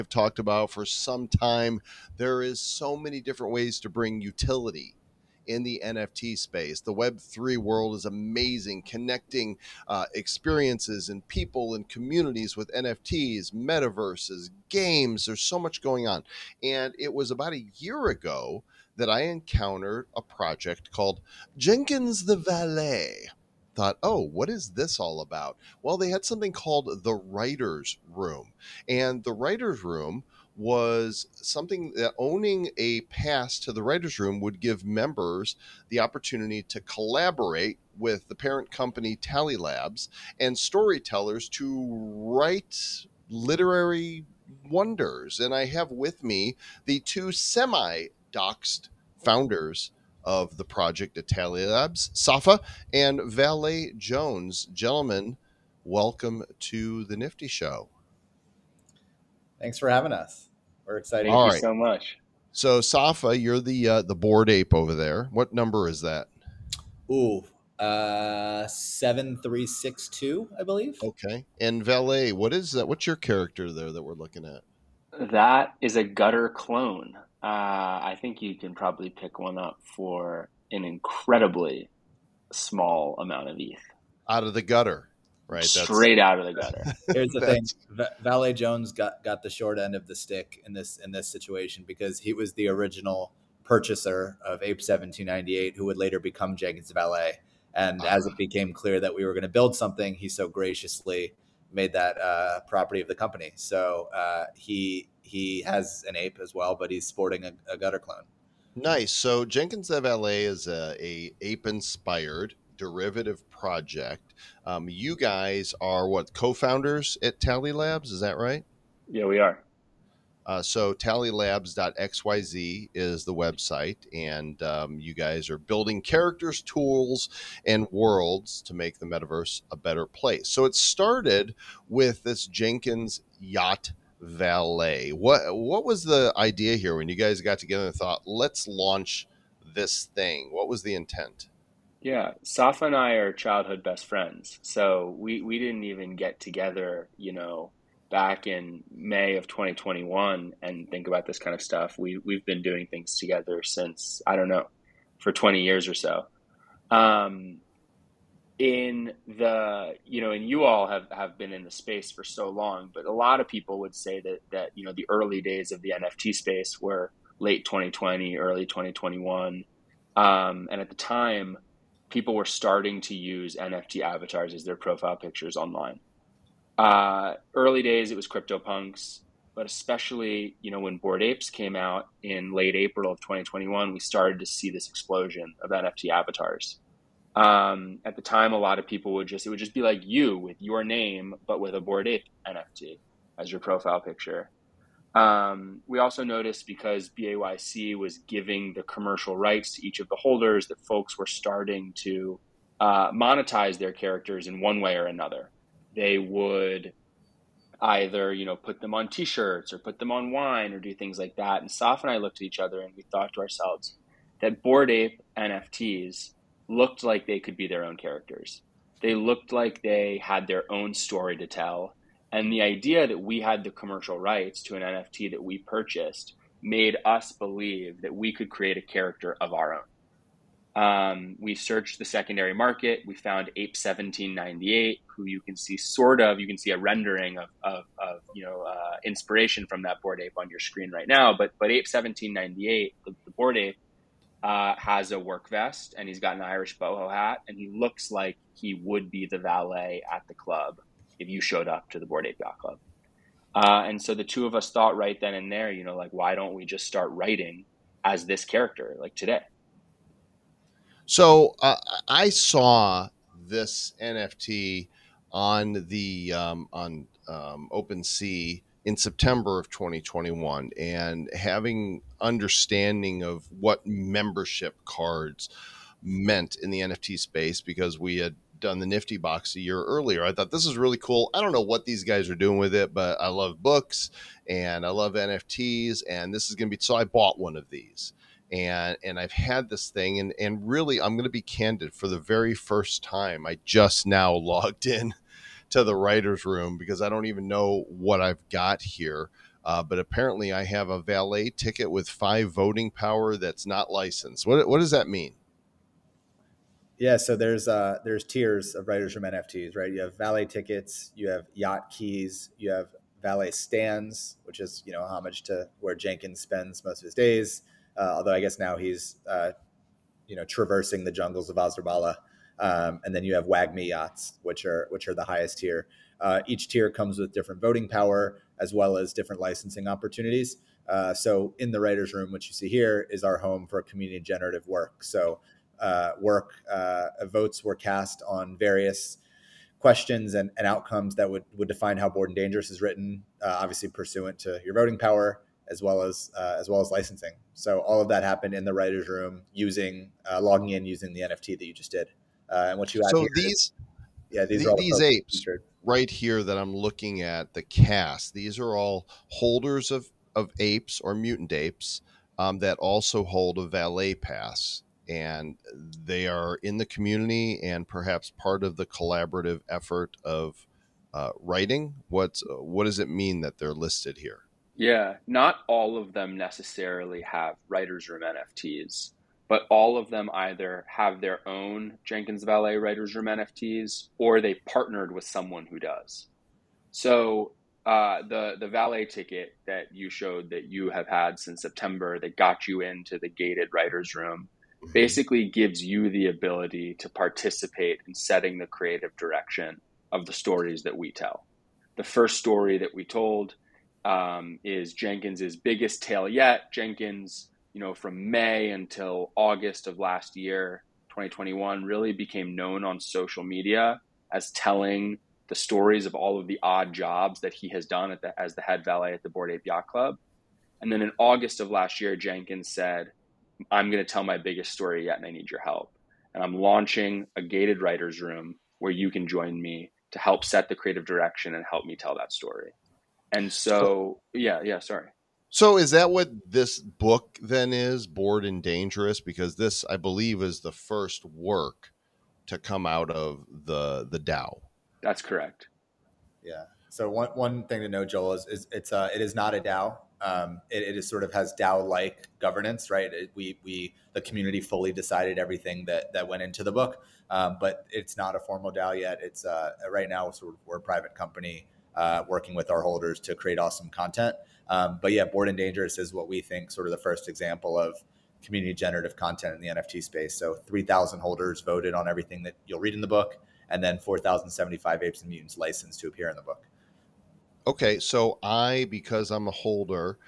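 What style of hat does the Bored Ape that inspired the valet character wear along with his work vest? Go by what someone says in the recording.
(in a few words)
Irish boho hat.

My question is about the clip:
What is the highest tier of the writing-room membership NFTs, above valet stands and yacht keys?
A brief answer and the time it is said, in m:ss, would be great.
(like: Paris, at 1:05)
WAGMI yachts, at 5:23.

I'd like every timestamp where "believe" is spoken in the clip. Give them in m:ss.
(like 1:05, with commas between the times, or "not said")
1:10, 3:47, 7:19.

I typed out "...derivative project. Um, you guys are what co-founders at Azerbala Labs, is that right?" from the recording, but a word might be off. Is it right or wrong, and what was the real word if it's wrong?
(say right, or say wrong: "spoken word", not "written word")
wrong: "Tally", not "Azerbala".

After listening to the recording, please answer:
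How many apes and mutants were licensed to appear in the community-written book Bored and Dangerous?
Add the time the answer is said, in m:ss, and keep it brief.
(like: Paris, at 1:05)
4,075, at 7:53.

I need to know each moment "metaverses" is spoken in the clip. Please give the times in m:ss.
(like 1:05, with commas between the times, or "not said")
0:13, 2:09.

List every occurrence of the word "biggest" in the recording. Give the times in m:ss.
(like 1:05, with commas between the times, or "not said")
6:45, 7:04.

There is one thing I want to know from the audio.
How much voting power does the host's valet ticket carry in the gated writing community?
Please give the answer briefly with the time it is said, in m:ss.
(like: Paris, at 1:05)
5, at 5:02.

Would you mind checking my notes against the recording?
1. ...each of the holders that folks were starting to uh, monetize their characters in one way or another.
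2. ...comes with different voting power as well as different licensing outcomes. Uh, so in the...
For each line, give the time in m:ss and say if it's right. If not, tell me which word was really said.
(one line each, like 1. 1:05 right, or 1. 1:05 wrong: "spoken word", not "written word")
1. 3:19 right
2. 5:26 wrong: "opportunities", not "outcomes".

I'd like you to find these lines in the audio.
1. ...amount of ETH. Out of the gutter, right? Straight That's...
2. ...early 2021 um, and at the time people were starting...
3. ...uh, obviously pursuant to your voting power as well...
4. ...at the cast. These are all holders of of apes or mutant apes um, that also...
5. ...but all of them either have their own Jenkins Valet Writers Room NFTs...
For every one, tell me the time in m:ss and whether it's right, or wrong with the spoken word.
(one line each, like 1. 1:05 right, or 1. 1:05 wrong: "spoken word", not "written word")
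1. 1:23 right
2. 2:48 right
3. 5:43 right
4. 5:57 right
5. 6:19 right.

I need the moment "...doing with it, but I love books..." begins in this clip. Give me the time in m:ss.
4:42.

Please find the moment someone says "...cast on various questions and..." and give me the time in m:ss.
5:37.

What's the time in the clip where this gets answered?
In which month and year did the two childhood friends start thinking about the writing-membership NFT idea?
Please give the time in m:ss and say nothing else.
2:28.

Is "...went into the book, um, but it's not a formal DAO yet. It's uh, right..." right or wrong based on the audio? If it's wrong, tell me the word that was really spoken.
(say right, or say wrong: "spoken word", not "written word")
right.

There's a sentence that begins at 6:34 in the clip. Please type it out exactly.
basically gives you the ability to participate in setting the creative direction of the stories that we tell.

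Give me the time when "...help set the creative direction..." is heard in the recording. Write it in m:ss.
7:10.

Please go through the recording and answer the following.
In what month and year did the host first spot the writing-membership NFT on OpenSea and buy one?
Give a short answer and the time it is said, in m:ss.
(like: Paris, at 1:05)
September 2021, at 4:28.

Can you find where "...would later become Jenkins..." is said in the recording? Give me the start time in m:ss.
1:35.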